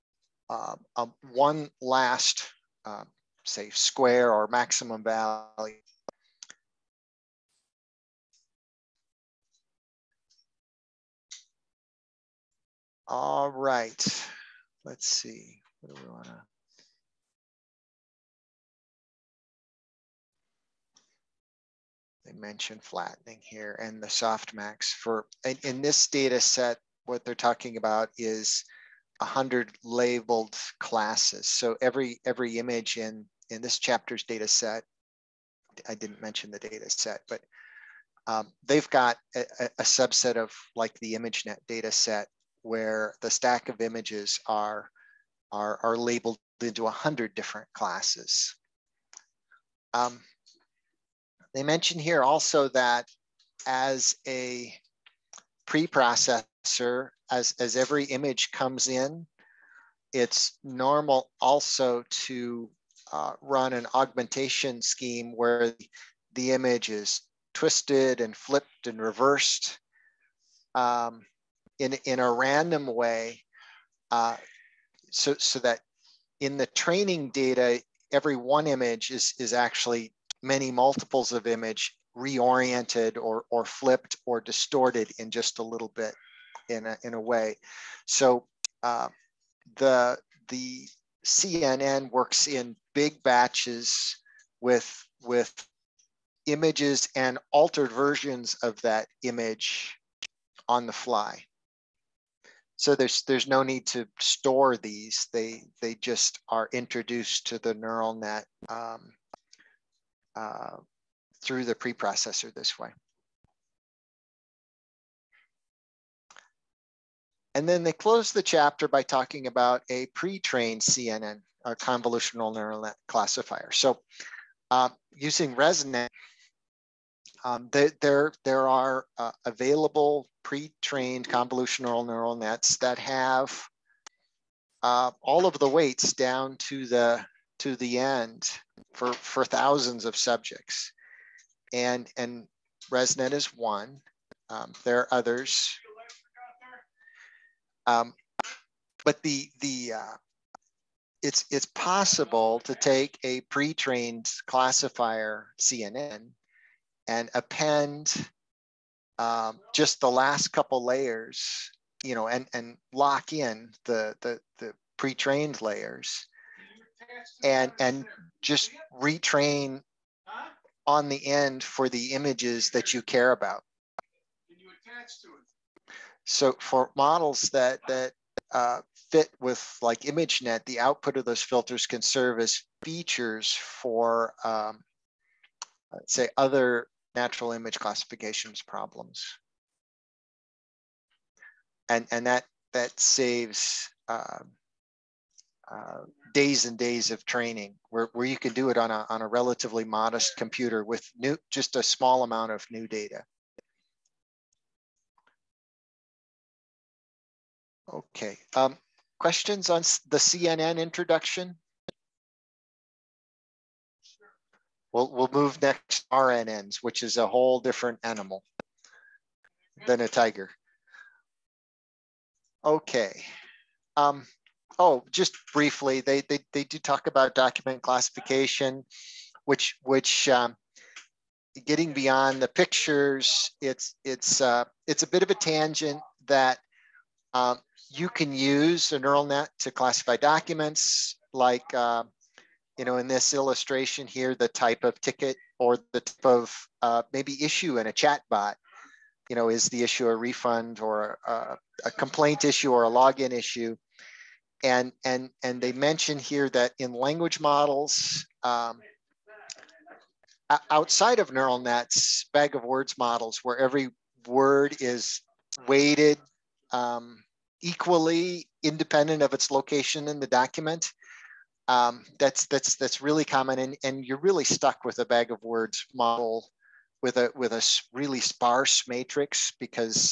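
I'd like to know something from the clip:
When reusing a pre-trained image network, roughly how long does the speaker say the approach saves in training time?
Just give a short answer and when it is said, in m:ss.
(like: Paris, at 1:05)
days and days, at 3:16.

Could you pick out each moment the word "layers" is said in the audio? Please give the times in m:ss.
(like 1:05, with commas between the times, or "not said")
2:40, 2:45.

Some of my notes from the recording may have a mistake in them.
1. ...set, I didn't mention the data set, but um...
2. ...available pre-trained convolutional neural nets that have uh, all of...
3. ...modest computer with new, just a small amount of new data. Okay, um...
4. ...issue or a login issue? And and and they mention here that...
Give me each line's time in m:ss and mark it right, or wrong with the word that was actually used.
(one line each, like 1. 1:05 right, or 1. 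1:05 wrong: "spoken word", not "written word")
1. 0:34 right
2. 2:09 right
3. 3:19 right
4. 4:12 right.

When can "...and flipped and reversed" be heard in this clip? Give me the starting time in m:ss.
1:08.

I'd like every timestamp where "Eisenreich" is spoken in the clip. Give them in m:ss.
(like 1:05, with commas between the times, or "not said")
not said.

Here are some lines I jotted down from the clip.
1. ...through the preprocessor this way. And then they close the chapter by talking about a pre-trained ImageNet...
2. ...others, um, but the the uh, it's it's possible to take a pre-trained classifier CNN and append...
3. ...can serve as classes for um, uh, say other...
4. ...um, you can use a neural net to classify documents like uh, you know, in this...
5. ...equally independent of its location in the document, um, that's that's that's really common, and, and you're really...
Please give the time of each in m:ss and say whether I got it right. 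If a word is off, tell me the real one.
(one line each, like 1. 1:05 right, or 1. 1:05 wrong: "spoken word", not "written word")
1. 1:51 wrong: "CNN", not "ImageNet"
2. 2:25 right
3. 3:01 wrong: "features", not "classes"
4. 3:57 right
5. 4:27 right.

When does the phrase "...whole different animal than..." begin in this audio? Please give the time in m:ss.
3:37.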